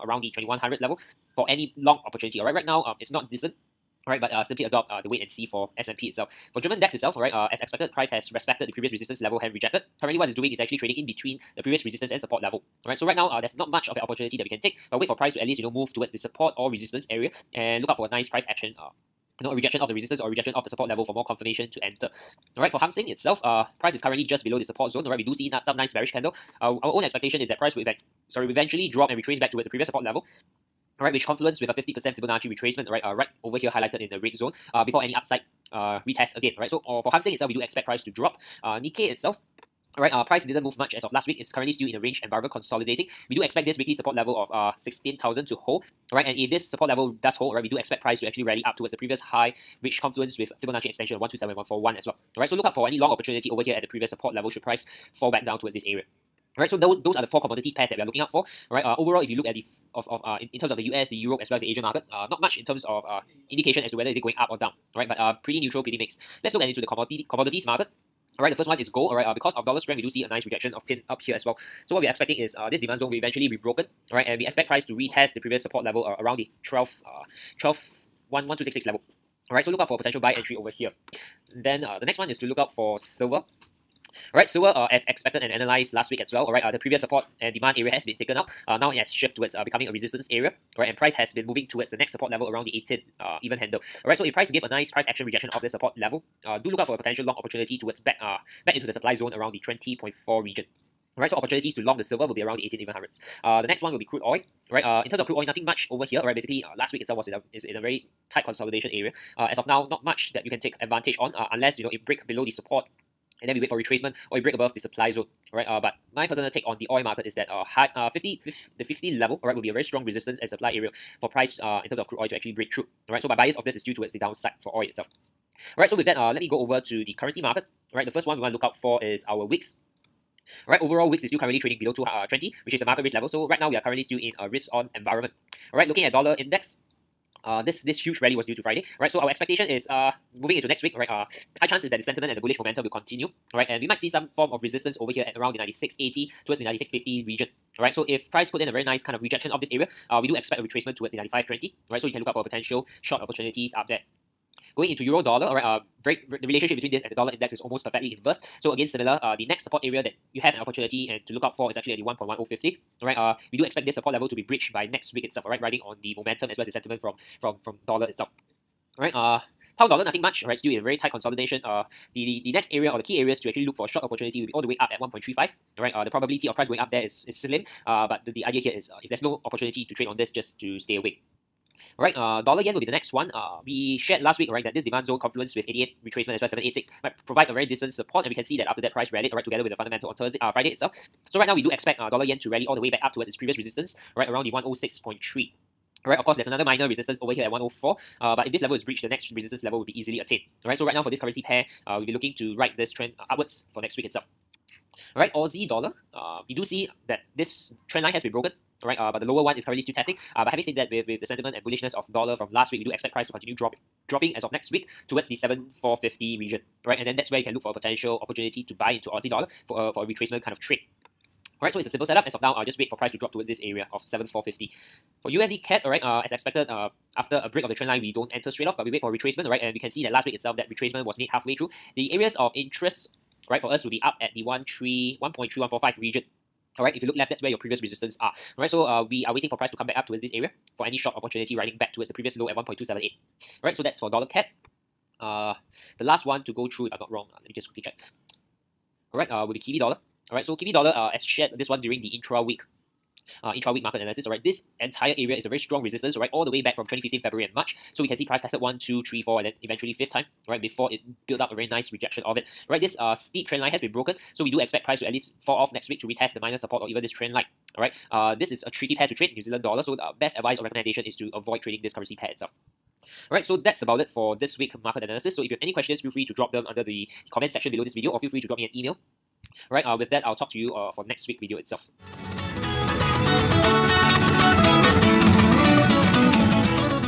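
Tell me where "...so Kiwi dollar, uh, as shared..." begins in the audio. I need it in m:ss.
4:10.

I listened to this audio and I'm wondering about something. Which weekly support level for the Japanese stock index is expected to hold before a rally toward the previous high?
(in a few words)
16,000.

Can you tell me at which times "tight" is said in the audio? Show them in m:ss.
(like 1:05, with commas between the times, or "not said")
1:48, 2:50.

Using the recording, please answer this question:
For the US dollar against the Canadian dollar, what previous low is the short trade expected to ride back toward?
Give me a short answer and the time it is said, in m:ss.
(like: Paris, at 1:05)
1.278, at 4:02.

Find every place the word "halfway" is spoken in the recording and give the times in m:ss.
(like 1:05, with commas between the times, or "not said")
3:51.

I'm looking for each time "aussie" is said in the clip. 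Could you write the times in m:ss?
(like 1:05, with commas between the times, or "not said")
3:25, 3:39.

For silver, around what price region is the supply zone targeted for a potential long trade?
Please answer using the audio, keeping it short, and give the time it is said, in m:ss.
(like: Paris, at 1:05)
20.4, at 1:39.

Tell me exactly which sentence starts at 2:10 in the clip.
Alright, overall VIX is still currently trading below 220, uh, which is the market risk level.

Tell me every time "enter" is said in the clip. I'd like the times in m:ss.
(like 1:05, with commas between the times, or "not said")
0:21, 3:48.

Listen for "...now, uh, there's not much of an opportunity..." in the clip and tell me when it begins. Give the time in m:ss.
0:13.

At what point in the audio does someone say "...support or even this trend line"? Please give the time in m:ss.
4:26.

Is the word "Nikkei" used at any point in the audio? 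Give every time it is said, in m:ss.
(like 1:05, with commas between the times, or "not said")
0:38.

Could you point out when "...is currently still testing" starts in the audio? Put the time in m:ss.
3:29.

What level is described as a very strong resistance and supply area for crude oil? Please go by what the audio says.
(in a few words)
50.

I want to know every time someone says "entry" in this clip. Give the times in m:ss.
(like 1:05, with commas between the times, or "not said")
1:20.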